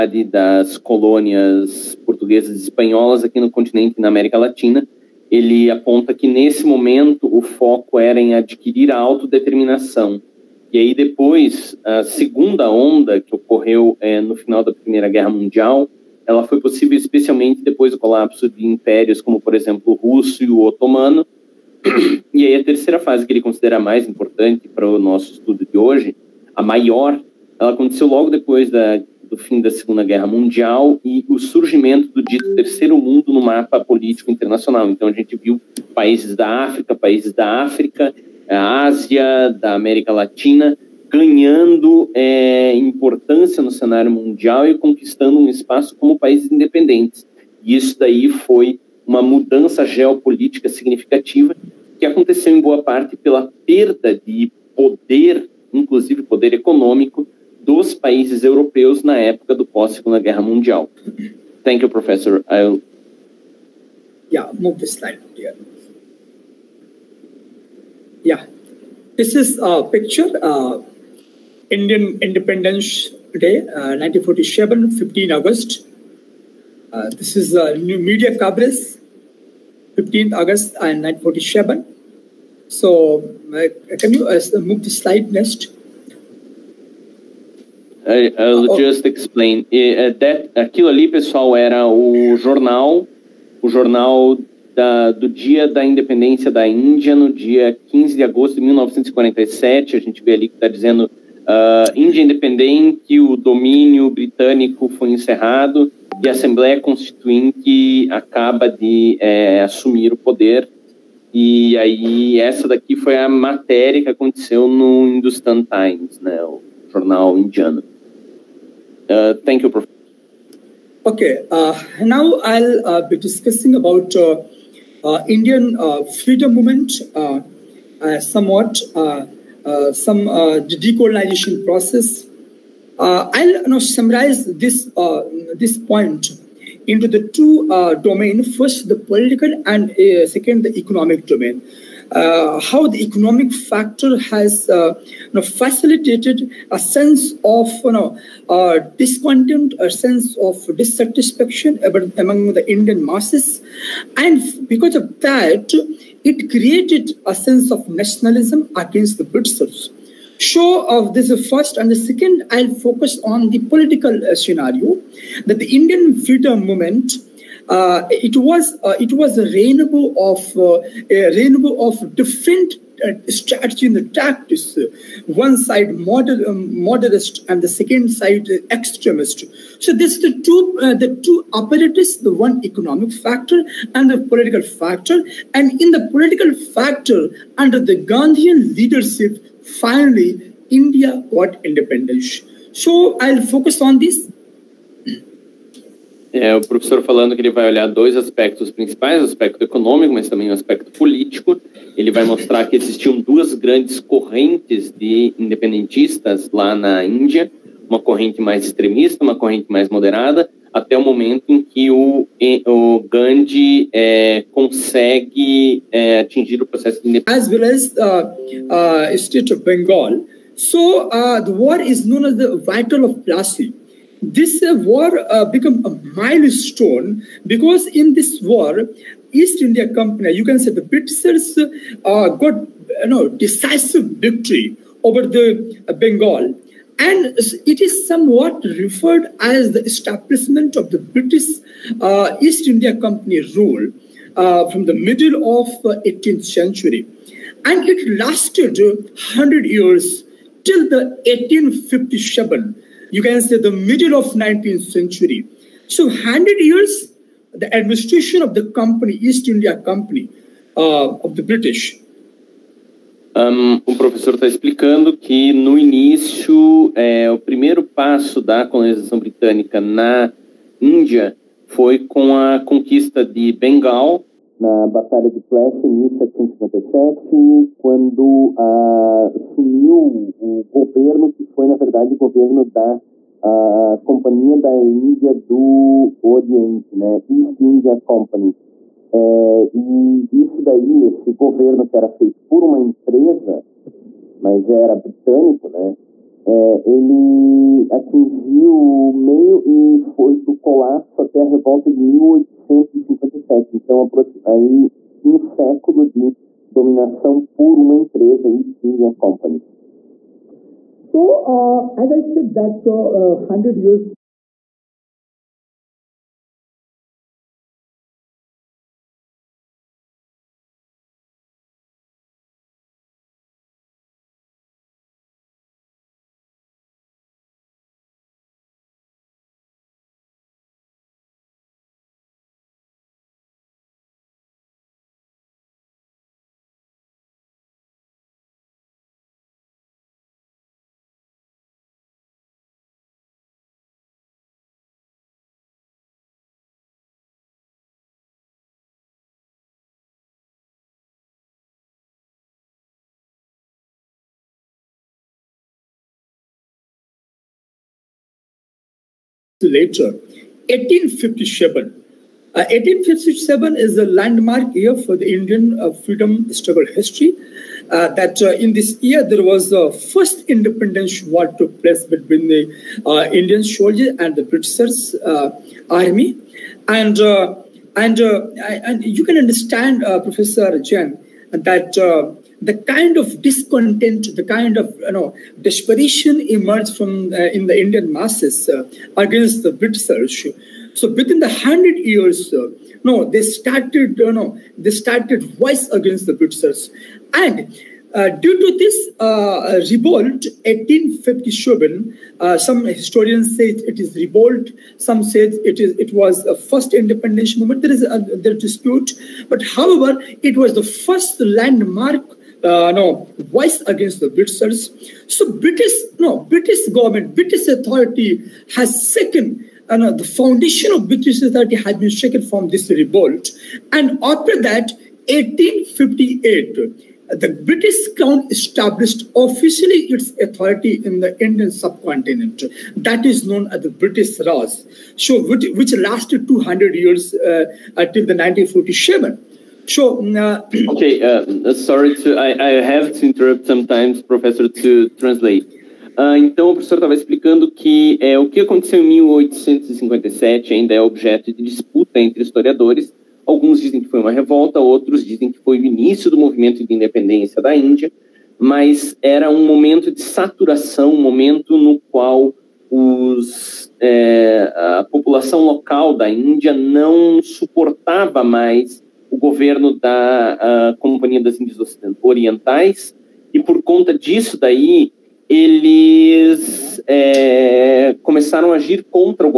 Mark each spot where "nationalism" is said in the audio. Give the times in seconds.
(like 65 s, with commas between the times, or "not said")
157 s.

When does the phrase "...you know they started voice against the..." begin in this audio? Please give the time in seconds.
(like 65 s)
394 s.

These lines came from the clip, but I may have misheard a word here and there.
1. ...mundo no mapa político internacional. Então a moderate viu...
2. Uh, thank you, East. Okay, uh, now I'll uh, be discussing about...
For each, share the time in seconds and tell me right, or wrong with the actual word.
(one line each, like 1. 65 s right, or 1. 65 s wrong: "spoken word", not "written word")
1. 32 s wrong: "gente", not "moderate"
2. 119 s wrong: "Professor", not "East".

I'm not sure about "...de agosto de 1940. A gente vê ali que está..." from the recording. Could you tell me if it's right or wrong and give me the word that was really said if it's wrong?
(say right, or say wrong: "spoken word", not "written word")
wrong: "1947", not "1940".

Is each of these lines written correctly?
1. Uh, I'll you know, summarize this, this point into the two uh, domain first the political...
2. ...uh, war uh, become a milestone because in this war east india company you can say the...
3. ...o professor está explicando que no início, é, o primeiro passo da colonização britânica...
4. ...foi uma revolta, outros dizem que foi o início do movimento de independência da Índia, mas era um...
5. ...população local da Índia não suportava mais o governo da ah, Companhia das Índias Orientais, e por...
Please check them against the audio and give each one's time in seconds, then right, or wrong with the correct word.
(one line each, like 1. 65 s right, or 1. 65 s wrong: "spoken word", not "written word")
1. 132 s right
2. 224 s right
3. 263 s right
4. 454 s right
5. 465 s right.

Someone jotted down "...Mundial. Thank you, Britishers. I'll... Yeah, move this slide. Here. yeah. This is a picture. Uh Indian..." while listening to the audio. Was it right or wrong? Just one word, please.
wrong.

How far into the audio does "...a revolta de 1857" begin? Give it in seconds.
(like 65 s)
301 s.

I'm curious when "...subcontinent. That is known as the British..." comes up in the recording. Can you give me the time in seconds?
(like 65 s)
431 s.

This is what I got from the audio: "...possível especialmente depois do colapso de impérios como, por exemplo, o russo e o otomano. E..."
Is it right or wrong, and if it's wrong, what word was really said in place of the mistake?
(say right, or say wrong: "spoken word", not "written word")
right.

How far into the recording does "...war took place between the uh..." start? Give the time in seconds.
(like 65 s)
371 s.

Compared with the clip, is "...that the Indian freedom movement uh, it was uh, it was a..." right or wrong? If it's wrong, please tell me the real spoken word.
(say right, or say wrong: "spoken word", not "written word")
right.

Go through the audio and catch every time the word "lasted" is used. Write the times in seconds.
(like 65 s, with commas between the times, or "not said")
248 s, 435 s.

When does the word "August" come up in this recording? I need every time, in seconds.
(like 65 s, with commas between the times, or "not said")
75 s, 80 s.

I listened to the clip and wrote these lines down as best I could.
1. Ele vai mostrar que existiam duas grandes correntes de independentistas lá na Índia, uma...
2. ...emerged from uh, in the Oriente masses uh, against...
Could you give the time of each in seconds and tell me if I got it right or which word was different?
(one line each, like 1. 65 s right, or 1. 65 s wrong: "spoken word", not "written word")
1. 201 s right
2. 386 s wrong: "Indian", not "Oriente".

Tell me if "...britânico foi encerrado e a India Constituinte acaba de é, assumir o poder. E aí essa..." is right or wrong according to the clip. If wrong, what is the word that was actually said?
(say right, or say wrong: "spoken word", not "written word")
wrong: "Assembleia", not "India".